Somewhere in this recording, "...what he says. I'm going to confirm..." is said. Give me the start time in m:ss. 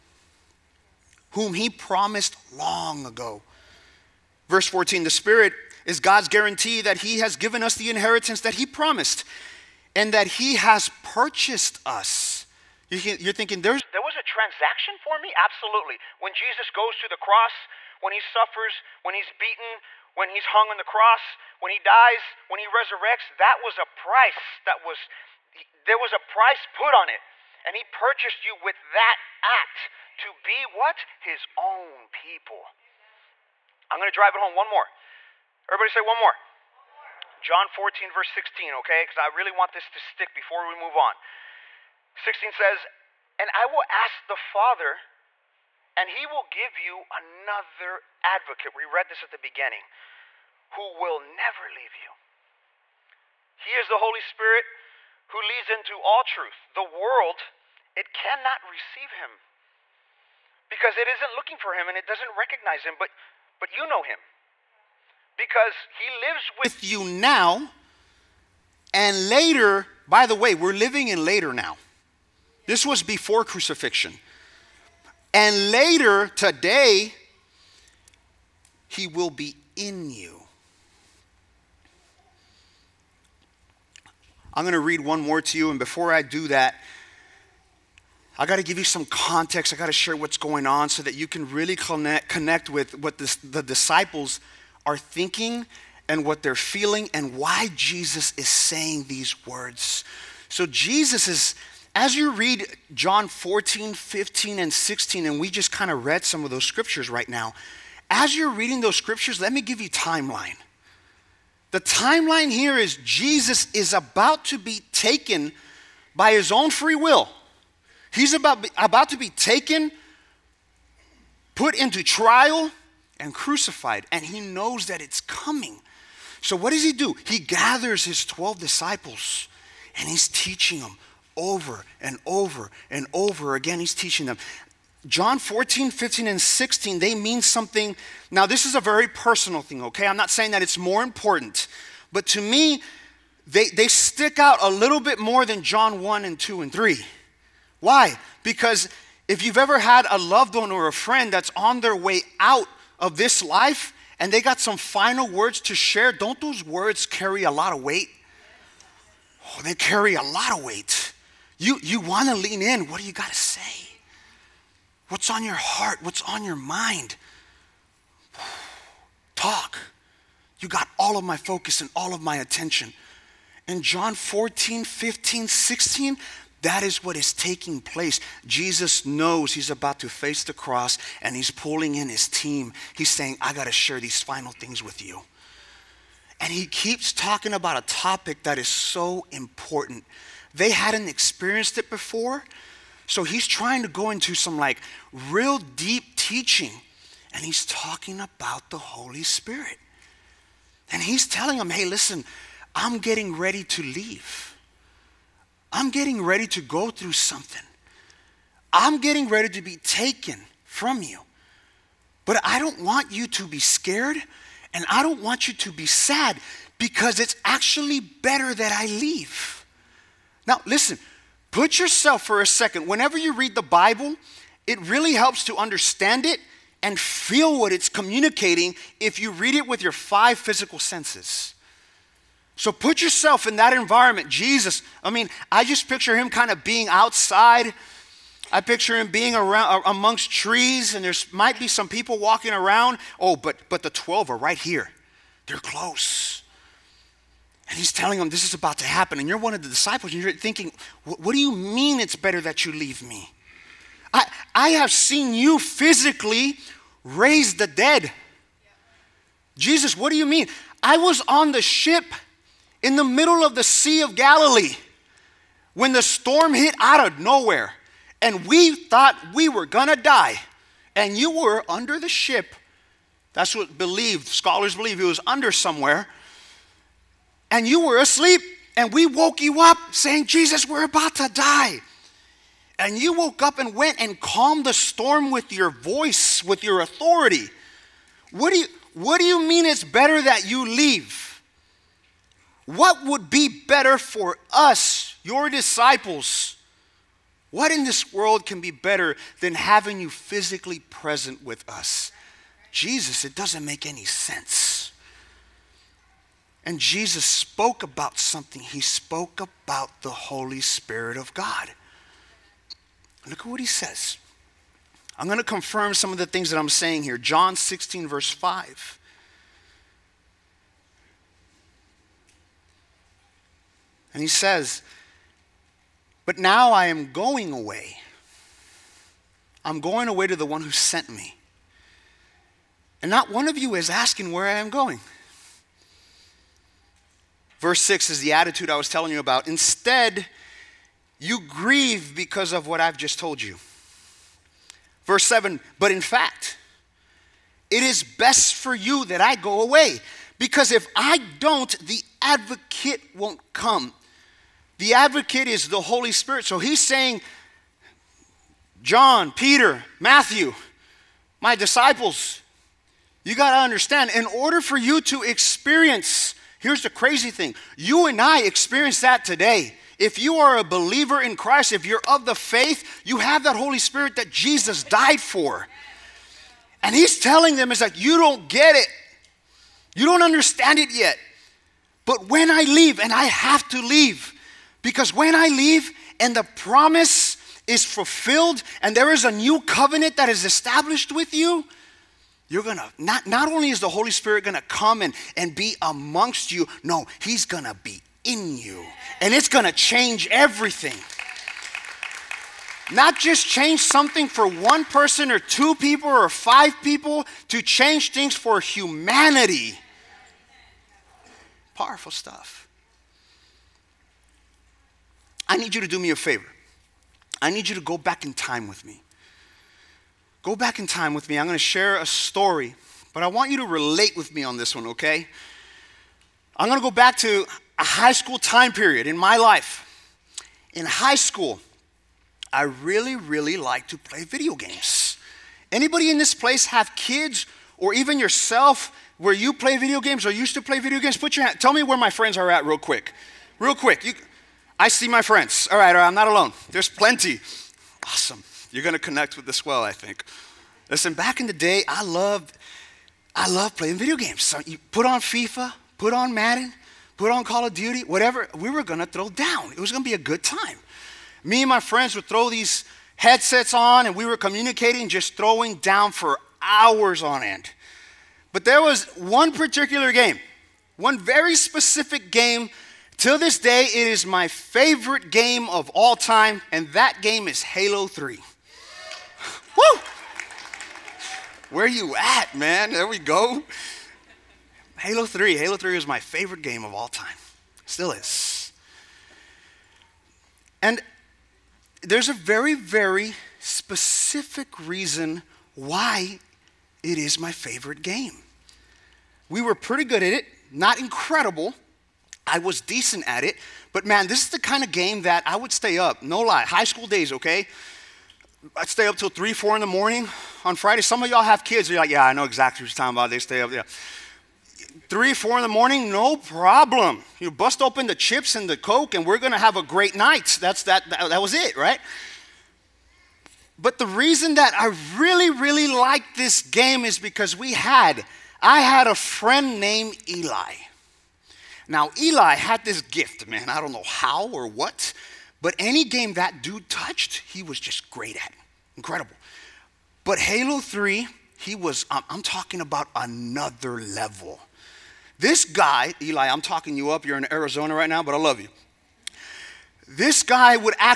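5:13.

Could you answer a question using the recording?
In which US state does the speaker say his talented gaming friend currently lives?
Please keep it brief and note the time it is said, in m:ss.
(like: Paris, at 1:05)
Arizona, at 9:07.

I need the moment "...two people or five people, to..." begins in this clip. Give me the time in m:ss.
6:45.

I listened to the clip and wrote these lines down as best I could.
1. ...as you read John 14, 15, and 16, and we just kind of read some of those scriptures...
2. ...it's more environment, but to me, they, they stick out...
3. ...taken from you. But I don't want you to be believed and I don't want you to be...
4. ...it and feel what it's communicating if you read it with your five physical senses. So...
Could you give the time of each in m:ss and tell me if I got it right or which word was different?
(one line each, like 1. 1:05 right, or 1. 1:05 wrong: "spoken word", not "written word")
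1. 1:41 right
2. 2:20 wrong: "important", not "environment"
3. 3:29 wrong: "scared", not "believed"
4. 3:46 right.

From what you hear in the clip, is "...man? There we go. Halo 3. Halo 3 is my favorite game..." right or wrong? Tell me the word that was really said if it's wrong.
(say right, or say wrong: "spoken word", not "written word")
right.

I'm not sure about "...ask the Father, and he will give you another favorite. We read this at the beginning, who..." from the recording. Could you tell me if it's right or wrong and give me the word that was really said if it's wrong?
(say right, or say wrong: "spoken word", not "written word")
wrong: "advocate", not "favorite".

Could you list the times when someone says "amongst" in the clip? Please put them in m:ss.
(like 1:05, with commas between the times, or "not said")
3:59, 6:35.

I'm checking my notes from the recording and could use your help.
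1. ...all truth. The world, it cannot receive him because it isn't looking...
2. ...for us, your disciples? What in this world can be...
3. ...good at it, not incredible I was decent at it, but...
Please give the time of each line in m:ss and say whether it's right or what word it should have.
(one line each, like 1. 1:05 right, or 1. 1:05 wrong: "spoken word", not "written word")
1. 0:56 right
2. 4:53 right
3. 8:20 right.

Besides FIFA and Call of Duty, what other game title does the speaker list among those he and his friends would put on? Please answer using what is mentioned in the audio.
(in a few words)
Madden.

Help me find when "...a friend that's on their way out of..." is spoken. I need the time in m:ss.
2:30.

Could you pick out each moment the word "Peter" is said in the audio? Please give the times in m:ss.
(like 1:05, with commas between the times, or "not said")
5:59.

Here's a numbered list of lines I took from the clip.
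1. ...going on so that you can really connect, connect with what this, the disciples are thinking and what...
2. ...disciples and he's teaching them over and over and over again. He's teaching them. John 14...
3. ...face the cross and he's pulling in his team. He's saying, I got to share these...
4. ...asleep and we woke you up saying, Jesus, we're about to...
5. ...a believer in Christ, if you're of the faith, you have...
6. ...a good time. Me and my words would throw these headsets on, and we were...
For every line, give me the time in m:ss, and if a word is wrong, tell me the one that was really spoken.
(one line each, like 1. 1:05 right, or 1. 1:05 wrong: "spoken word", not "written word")
1. 1:30 right
2. 2:08 right
3. 3:00 right
4. 4:37 right
5. 6:10 right
6. 7:40 wrong: "friends", not "words".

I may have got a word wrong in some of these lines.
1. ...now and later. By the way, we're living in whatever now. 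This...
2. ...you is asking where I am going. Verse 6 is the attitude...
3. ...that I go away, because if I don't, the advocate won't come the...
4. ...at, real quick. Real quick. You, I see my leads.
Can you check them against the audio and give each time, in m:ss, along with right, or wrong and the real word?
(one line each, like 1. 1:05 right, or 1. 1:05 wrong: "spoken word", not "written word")
1. 1:07 wrong: "later", not "whatever"
2. 5:33 right
3. 5:49 right
4. 7:22 wrong: "friends", not "leads".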